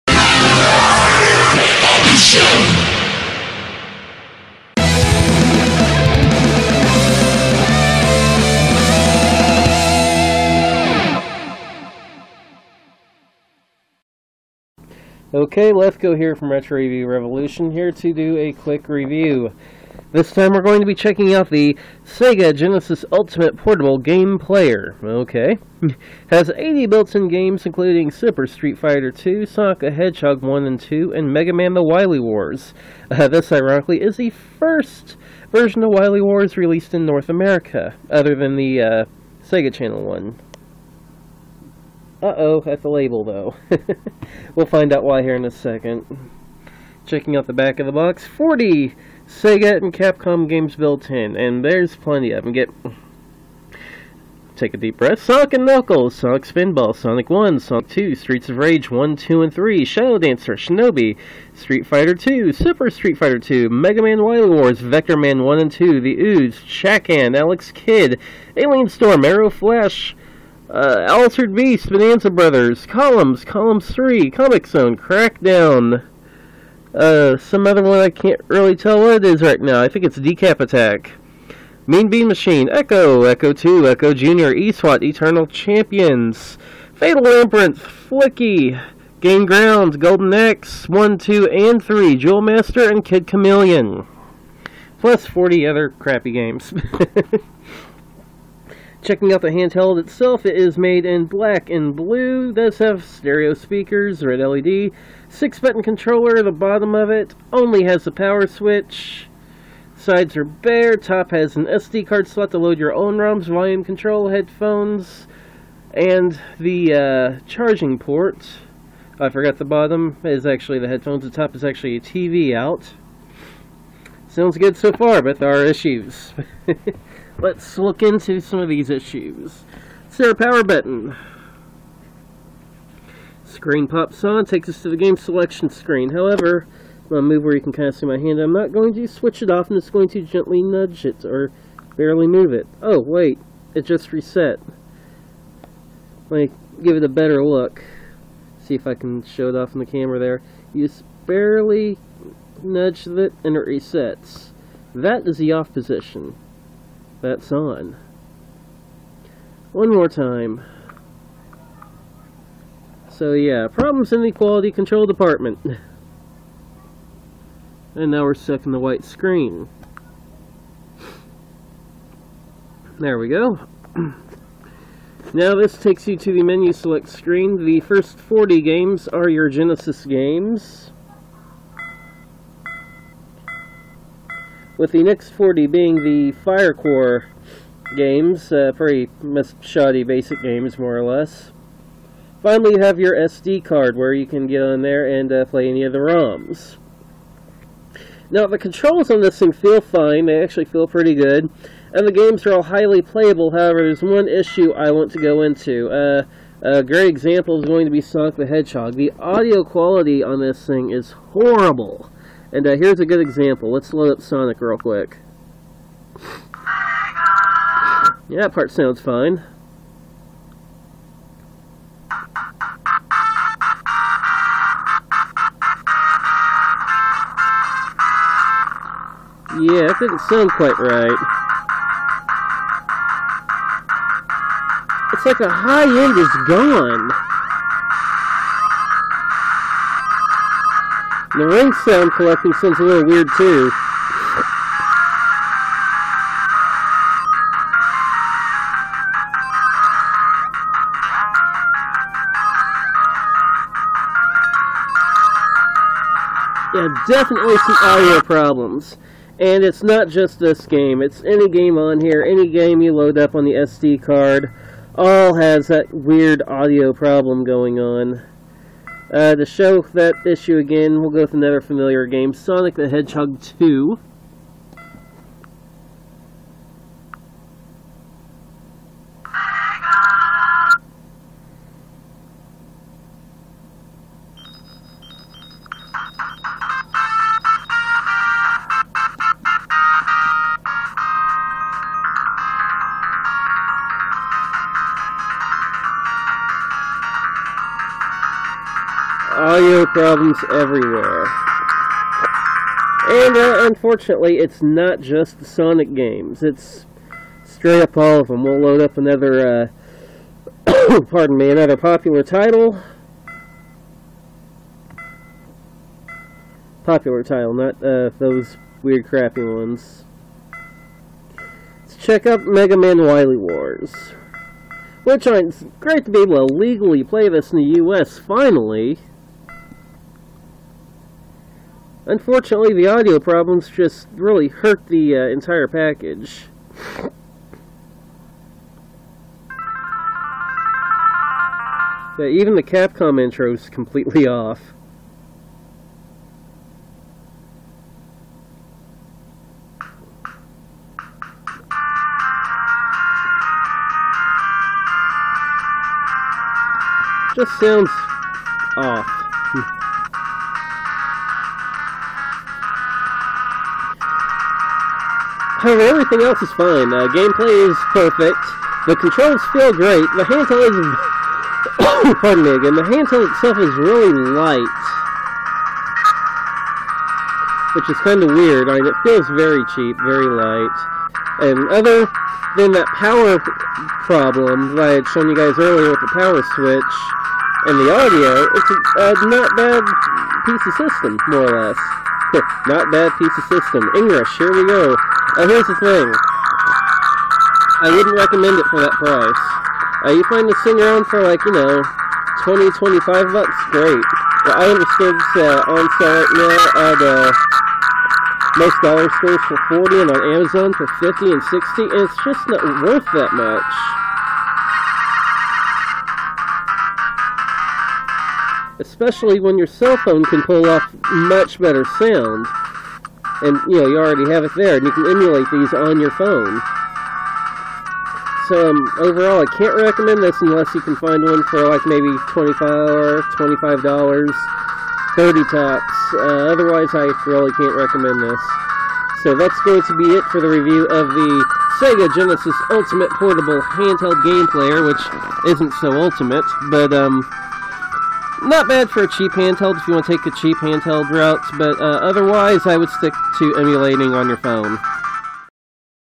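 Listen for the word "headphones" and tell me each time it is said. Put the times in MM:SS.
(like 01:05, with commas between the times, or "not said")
01:54, 02:00.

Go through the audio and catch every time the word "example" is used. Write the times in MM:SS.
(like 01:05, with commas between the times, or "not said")
03:27, 03:33.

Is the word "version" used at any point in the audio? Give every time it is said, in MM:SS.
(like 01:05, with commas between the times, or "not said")
00:35.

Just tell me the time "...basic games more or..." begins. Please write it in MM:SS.
03:10.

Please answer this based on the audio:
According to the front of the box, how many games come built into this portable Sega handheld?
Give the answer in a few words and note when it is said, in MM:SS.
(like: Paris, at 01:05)
80, at 00:26.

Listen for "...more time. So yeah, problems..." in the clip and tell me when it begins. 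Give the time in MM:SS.
02:39.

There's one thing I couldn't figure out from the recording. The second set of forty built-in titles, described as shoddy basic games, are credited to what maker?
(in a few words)
Fire Core.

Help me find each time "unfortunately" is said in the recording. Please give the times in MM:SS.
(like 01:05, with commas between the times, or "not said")
05:03, 05:32.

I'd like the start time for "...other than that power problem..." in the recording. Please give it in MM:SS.
06:21.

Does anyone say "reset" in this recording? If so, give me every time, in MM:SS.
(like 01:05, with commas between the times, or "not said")
02:24, 02:33.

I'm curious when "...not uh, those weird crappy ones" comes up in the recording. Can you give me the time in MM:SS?
05:17.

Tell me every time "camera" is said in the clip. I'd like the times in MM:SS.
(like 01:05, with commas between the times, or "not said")
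02:29.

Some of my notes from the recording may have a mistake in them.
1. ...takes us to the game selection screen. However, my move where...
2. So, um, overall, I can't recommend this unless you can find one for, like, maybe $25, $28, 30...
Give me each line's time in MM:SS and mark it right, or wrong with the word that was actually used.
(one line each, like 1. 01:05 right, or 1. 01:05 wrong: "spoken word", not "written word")
1. 02:14 right
2. 07:08 wrong: "25", not "28".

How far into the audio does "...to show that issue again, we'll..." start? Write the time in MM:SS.
04:29.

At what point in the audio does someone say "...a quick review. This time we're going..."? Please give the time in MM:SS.
00:18.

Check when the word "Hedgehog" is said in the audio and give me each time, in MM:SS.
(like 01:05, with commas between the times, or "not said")
00:29, 03:28, 04:32.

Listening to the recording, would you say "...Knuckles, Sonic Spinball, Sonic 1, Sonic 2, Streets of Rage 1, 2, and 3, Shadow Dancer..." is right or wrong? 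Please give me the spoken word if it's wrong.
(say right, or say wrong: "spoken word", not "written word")
right.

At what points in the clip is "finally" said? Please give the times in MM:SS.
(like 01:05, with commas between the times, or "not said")
03:12, 05:28.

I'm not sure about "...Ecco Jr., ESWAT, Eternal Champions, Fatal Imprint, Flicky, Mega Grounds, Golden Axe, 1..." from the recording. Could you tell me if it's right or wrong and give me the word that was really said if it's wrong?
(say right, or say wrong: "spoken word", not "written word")
wrong: "Game", not "Mega".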